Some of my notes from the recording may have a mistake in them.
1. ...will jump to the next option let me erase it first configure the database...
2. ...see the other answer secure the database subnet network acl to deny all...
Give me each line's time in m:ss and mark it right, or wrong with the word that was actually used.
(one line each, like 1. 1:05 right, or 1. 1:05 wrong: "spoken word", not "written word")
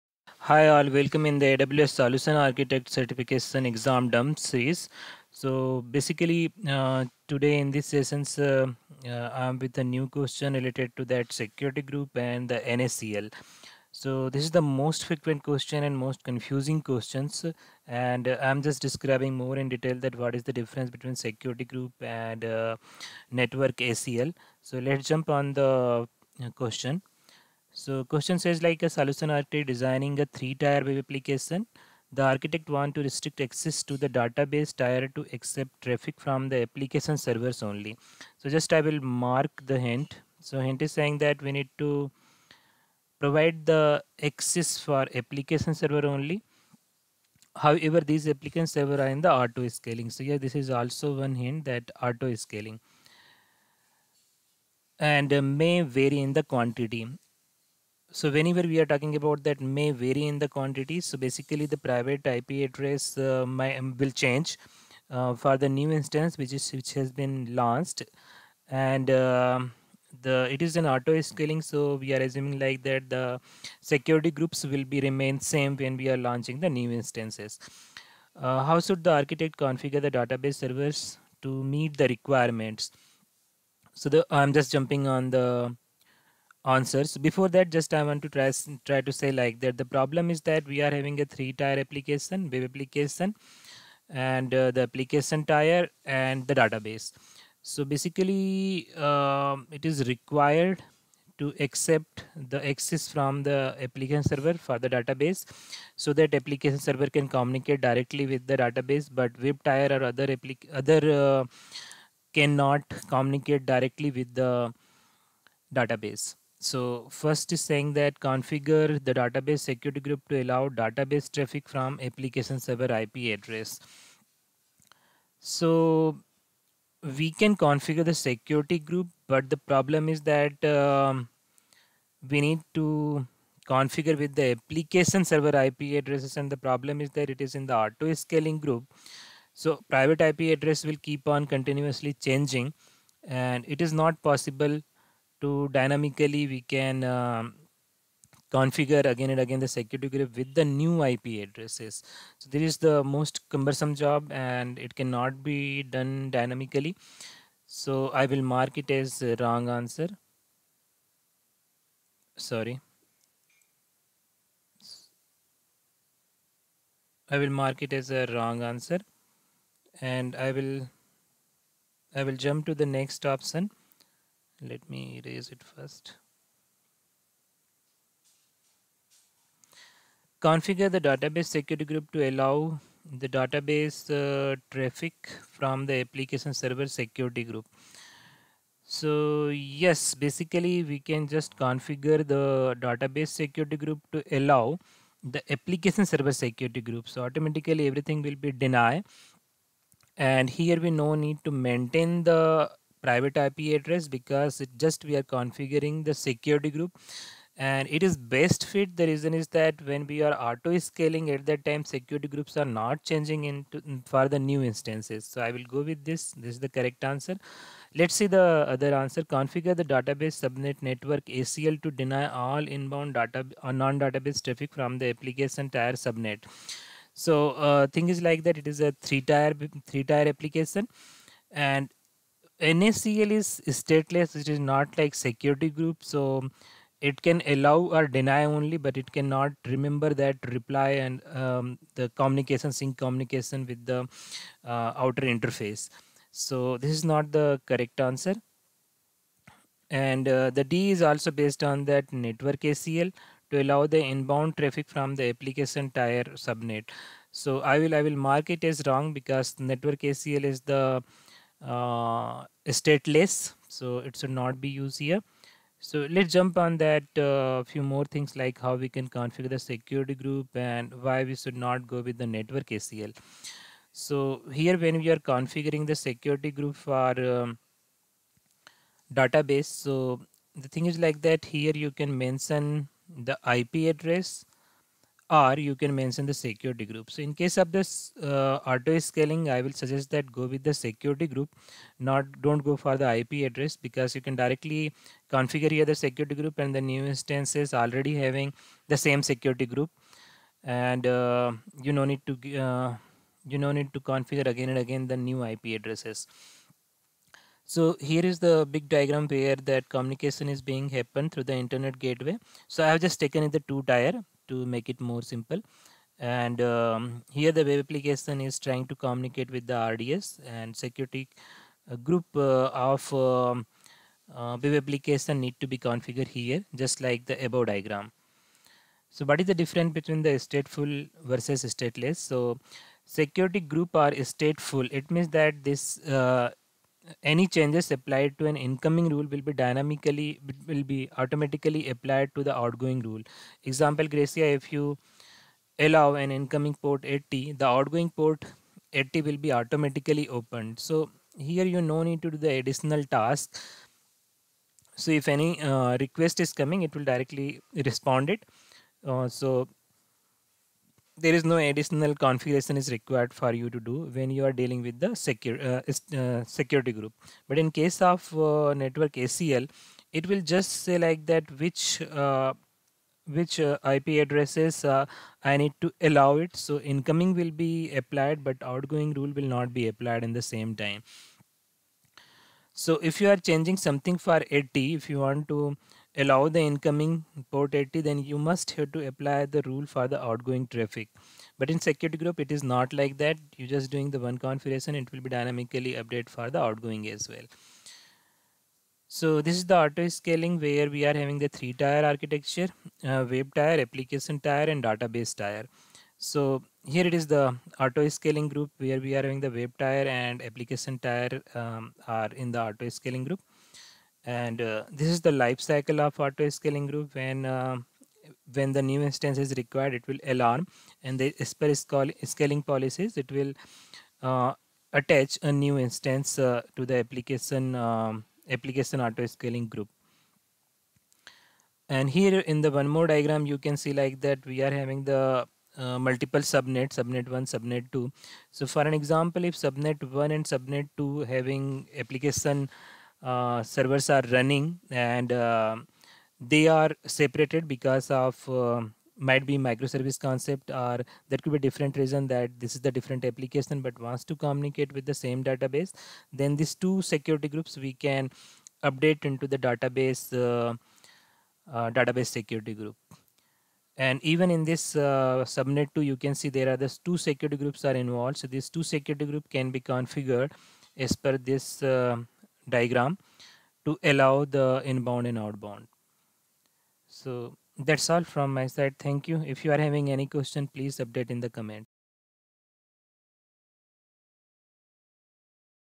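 1. 2:52 right
2. 3:38 wrong: "configure", not "secure".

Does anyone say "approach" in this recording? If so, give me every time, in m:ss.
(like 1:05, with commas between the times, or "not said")
not said.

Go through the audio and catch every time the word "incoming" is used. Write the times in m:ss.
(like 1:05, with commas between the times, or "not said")
5:38, 5:46, 6:16, 6:26.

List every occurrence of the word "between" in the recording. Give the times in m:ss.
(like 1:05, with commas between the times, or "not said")
0:20, 5:29.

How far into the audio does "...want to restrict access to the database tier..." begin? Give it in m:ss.
0:32.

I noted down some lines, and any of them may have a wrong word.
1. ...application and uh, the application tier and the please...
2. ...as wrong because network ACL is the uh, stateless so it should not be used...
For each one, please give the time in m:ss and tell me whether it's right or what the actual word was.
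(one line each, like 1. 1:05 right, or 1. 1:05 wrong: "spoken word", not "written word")
1. 1:32 wrong: "database", not "please"
2. 4:18 right.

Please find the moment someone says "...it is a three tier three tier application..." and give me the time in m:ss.
3:48.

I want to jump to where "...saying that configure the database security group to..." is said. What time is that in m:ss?
1:57.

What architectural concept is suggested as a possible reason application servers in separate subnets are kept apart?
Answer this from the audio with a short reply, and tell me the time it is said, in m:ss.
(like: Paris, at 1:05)
microservice, at 7:29.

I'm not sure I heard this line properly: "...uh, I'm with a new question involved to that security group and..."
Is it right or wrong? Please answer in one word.
wrong.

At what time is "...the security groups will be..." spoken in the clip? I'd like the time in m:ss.
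1:13.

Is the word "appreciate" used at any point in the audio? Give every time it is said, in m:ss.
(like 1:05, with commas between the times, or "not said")
not said.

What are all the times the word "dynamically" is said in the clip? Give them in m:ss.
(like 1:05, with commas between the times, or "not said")
2:25, 2:36, 5:39, 6:35.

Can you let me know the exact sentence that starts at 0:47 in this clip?
However, these application server are in the auto scaling.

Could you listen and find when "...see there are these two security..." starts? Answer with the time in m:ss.
7:46.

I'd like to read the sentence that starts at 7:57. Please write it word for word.
So that's all from my side.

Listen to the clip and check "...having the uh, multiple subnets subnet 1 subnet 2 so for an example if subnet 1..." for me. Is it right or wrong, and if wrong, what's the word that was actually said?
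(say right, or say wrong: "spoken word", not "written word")
right.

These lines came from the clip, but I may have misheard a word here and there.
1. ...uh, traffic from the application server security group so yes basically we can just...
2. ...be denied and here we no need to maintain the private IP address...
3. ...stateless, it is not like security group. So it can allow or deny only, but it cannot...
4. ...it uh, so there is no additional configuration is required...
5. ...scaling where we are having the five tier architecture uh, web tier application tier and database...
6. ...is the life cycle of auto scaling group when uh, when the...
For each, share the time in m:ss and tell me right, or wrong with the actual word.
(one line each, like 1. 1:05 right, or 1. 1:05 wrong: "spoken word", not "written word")
1. 3:04 right
2. 3:18 right
3. 3:53 right
4. 5:58 right
5. 6:40 wrong: "three", not "five"
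6. 6:55 right.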